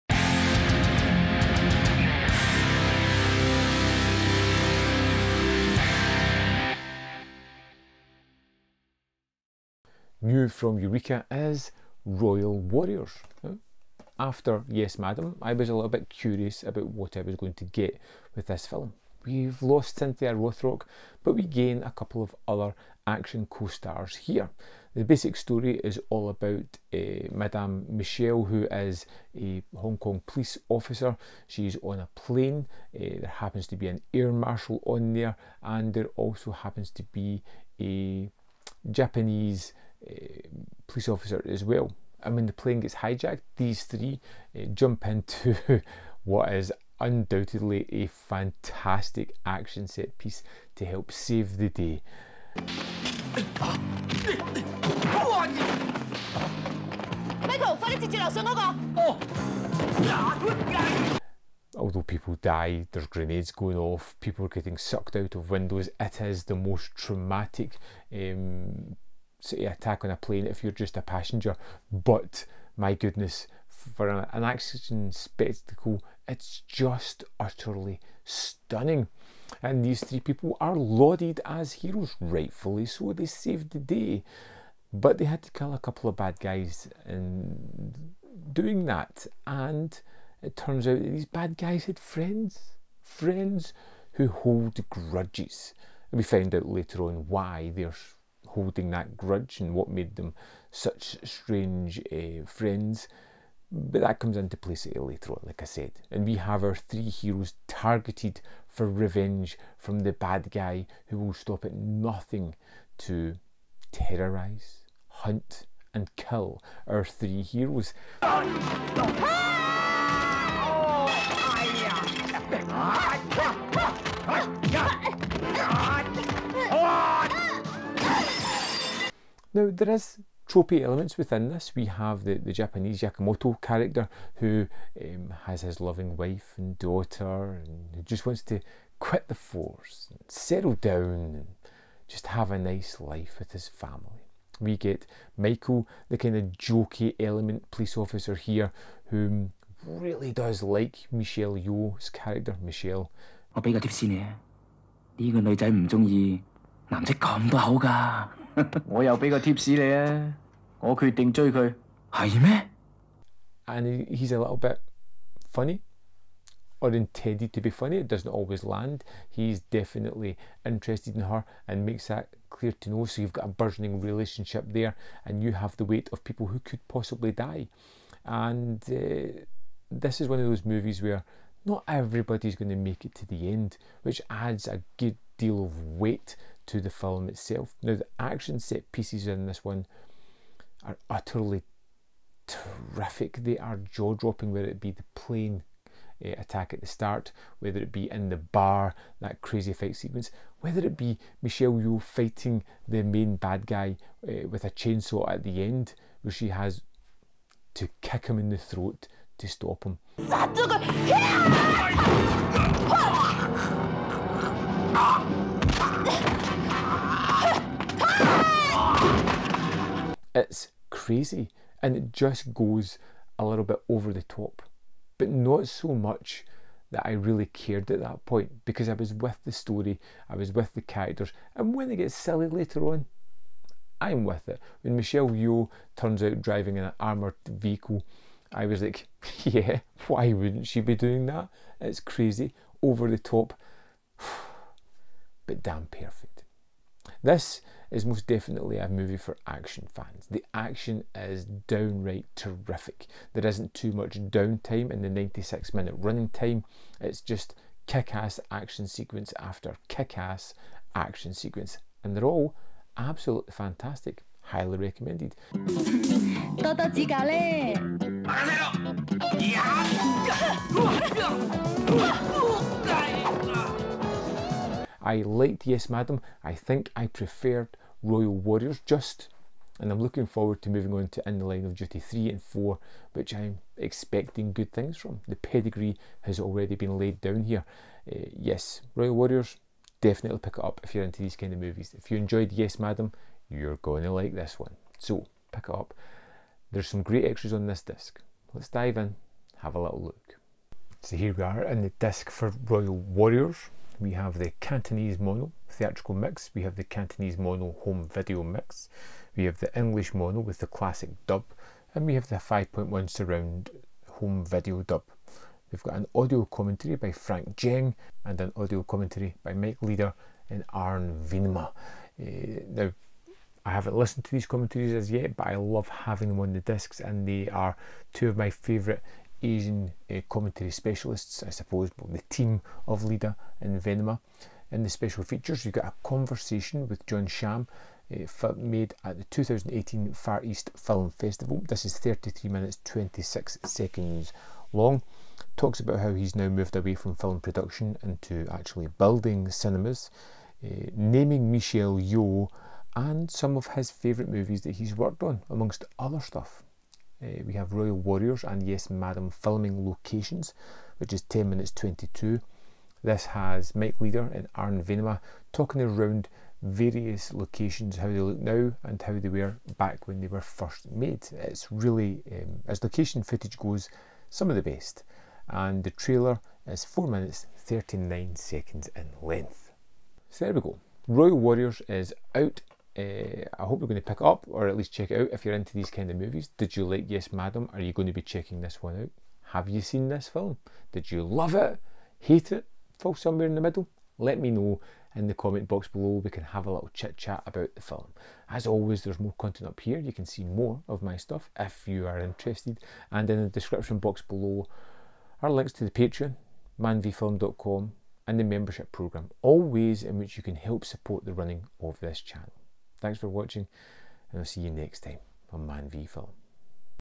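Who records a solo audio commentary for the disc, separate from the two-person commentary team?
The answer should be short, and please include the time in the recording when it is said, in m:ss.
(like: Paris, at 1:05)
Frank Djeng, at 5:17.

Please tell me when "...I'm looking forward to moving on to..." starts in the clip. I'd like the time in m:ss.
4:39.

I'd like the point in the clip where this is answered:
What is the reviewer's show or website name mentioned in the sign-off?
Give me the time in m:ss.
6:55.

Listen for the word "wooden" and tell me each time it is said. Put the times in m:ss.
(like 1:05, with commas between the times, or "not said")
not said.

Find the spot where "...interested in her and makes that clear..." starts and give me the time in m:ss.
2:50.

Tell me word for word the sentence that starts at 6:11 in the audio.
It's really, um, as location footage goes, some of the best.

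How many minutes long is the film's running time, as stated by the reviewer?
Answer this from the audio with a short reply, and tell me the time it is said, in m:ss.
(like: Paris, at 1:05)
96, at 4:15.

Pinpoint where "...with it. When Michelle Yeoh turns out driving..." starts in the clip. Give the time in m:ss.
3:54.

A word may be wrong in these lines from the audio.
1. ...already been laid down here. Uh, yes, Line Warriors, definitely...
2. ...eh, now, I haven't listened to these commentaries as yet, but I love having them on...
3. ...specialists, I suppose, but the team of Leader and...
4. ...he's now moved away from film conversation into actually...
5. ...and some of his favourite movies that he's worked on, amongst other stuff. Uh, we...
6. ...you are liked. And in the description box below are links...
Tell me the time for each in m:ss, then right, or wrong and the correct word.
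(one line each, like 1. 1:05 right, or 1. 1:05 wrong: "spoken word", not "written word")
1. 4:46 wrong: "Royal", not "Line"
2. 5:22 right
3. 5:30 right
4. 5:46 wrong: "production", not "conversation"
5. 5:52 right
6. 6:41 wrong: "interested", not "liked".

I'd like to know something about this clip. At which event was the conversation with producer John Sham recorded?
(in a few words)
2018 Far East Film Festival.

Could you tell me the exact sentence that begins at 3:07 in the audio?
Now, the action set pieces in this one are utterly terrific.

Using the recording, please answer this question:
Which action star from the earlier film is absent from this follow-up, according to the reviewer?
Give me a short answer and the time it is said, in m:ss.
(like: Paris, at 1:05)
Cynthia Rothrock, at 0:19.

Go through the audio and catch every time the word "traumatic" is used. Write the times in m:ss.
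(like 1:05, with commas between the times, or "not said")
1:06.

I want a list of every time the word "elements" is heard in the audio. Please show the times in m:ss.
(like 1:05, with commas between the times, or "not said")
2:10, 2:27.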